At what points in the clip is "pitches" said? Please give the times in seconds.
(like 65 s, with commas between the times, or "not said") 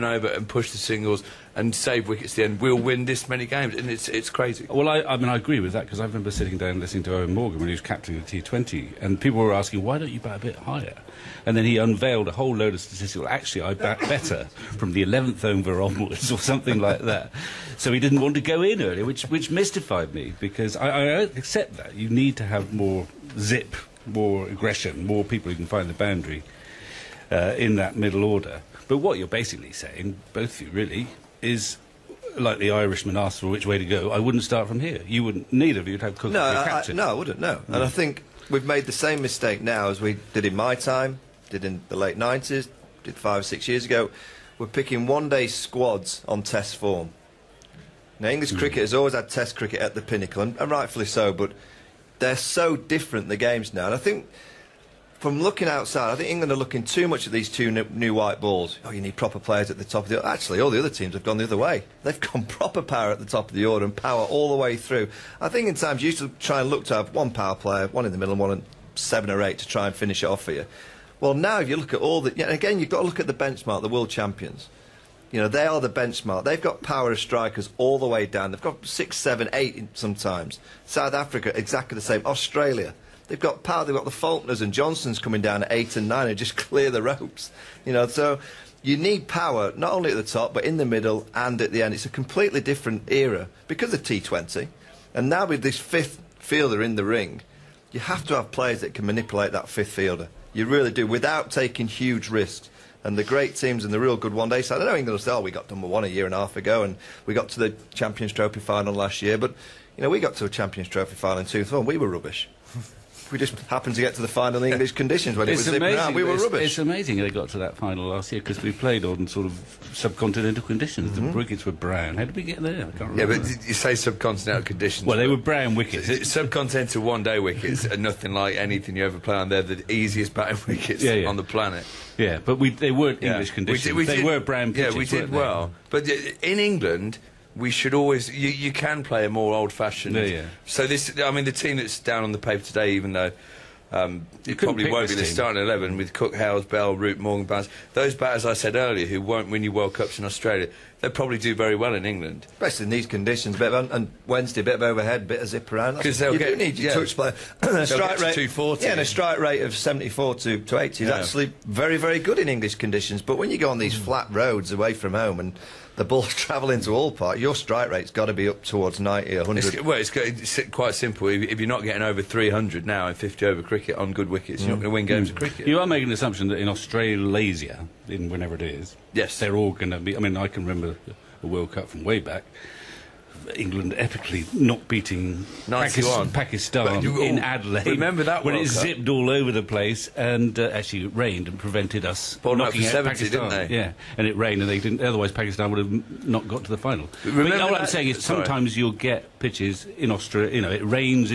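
134 s, 199 s.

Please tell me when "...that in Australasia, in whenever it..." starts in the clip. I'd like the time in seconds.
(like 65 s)
176 s.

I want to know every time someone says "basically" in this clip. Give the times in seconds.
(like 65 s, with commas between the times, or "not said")
29 s.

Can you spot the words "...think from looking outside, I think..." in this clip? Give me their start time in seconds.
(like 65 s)
53 s.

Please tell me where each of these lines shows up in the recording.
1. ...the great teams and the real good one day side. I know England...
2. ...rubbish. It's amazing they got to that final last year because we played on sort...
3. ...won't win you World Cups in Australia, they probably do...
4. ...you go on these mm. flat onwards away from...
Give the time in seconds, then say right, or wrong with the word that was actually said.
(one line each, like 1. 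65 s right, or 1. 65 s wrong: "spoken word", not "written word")
1. 103 s right
2. 116 s right
3. 149 s right
4. 163 s wrong: "roads", not "onwards".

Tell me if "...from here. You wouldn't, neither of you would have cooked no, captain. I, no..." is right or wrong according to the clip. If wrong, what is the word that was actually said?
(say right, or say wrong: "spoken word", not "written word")
right.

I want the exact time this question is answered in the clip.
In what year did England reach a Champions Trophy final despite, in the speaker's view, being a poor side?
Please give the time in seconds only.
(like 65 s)
111 s.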